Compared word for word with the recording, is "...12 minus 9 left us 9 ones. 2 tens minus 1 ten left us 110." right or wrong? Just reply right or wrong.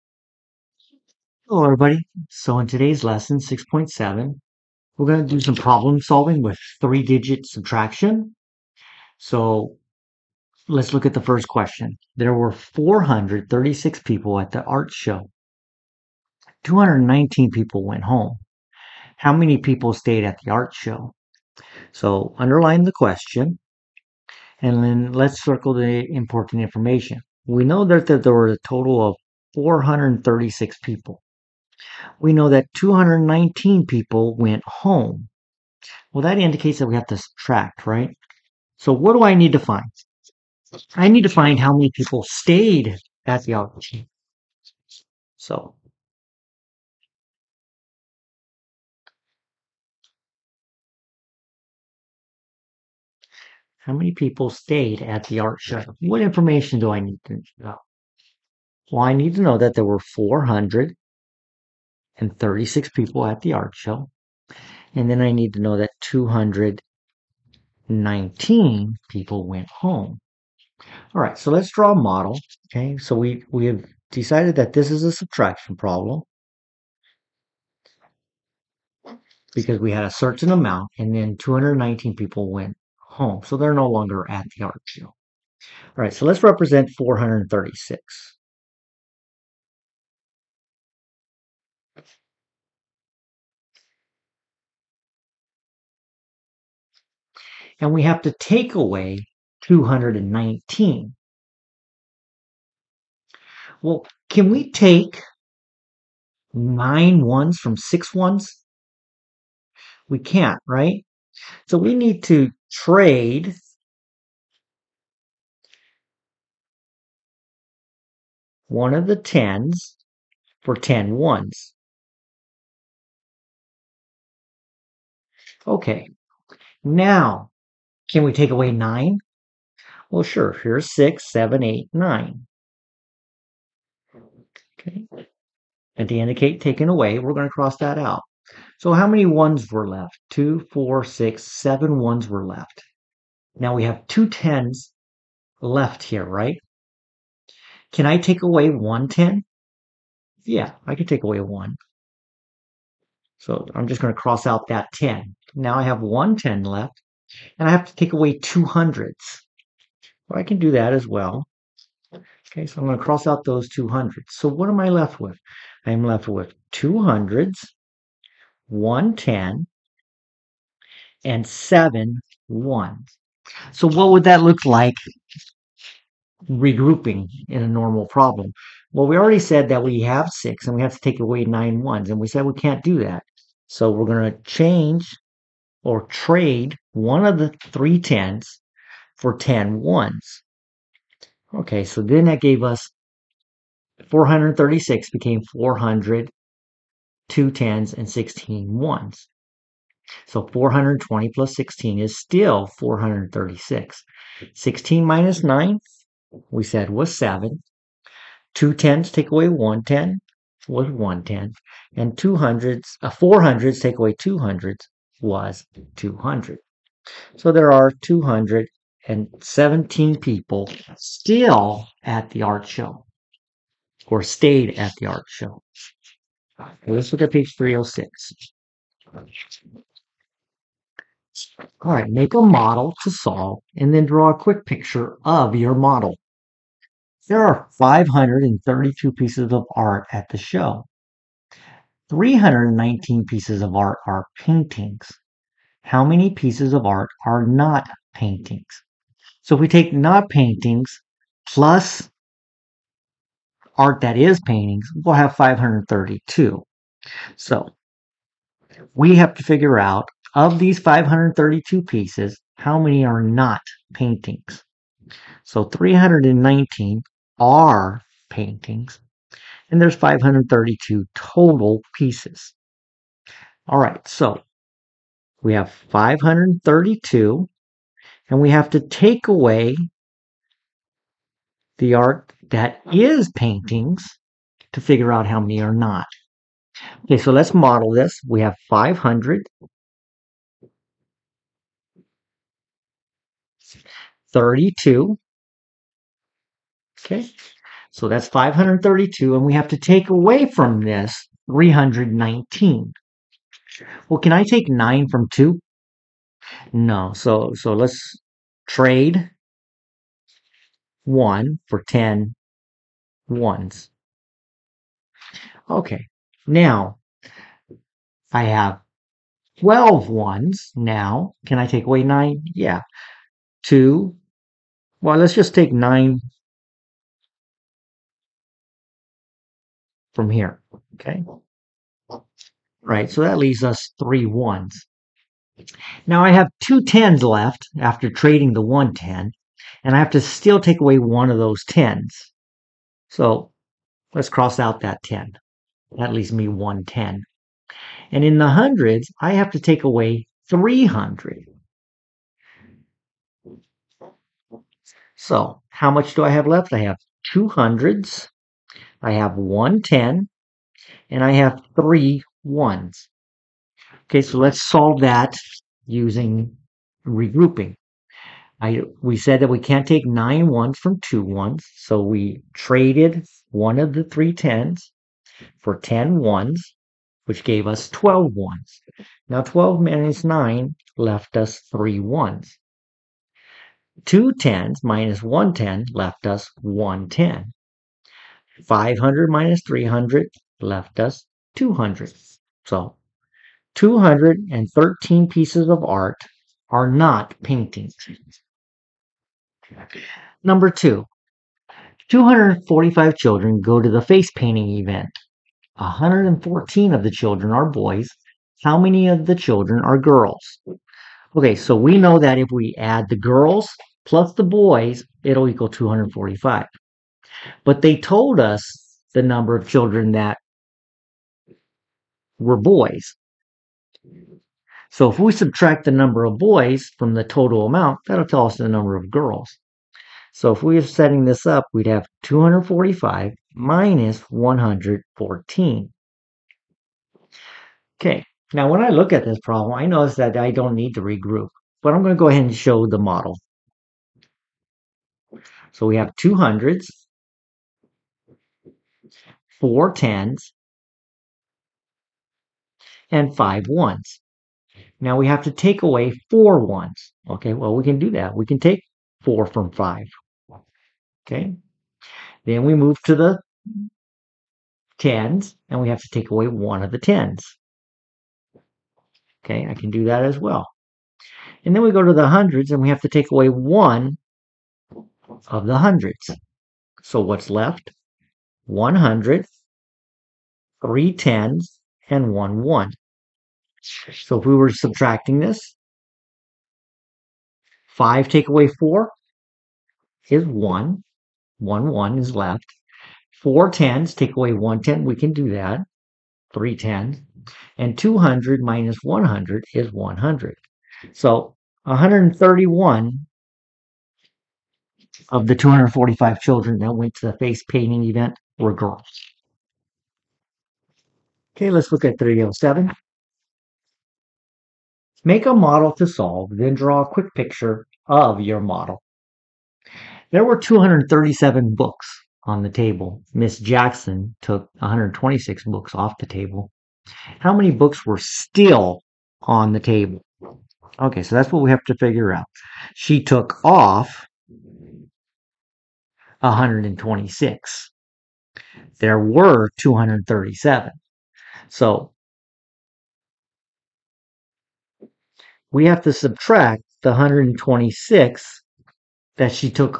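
wrong.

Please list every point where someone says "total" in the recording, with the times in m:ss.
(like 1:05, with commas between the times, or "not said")
0:28, 4:31, 7:07.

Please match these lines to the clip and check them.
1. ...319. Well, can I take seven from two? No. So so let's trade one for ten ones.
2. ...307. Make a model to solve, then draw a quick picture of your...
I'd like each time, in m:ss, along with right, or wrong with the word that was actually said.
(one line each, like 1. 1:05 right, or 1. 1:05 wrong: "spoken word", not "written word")
1. 5:01 wrong: "nine", not "seven"
2. 8:32 right.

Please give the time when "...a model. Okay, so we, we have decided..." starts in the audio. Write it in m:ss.
1:11.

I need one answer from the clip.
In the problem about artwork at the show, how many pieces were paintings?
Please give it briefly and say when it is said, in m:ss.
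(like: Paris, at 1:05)
319, at 4:02.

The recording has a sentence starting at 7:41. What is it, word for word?
Okay, then we move to the tens and we have to take away one of the tens.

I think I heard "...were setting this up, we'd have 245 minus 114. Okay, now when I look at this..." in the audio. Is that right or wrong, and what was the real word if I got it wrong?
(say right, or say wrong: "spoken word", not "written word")
right.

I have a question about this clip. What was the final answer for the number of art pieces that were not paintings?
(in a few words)
213.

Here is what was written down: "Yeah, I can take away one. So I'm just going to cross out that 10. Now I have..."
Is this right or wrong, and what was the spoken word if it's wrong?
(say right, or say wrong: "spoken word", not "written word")
right.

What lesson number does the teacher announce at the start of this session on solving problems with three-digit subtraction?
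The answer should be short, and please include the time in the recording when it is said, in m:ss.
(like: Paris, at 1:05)
6.7, at 0:03.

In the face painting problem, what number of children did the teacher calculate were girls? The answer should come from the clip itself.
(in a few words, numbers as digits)
131.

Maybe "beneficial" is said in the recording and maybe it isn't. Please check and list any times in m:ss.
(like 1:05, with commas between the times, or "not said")
not said.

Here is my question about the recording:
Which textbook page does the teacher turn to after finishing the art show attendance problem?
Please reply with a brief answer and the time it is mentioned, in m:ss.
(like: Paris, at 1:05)
306, at 3:47.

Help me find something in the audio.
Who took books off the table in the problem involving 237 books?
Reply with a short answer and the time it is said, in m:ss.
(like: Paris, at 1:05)
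Miss Jackson, at 8:43.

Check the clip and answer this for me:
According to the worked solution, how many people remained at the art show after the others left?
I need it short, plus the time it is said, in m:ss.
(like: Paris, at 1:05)
217, at 3:37.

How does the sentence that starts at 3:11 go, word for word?
Okay, so then that gave us 436 became 400, two tens, and 16 ones.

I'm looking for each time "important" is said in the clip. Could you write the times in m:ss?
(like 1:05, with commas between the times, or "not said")
0:26.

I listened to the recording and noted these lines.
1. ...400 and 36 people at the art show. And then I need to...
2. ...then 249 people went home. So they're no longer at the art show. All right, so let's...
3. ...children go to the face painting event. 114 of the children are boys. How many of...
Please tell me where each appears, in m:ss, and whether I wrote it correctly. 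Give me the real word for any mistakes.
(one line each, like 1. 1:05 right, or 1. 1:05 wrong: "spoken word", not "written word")
1. 0:59 right
2. 1:21 wrong: "219", not "249"
3. 6:43 right.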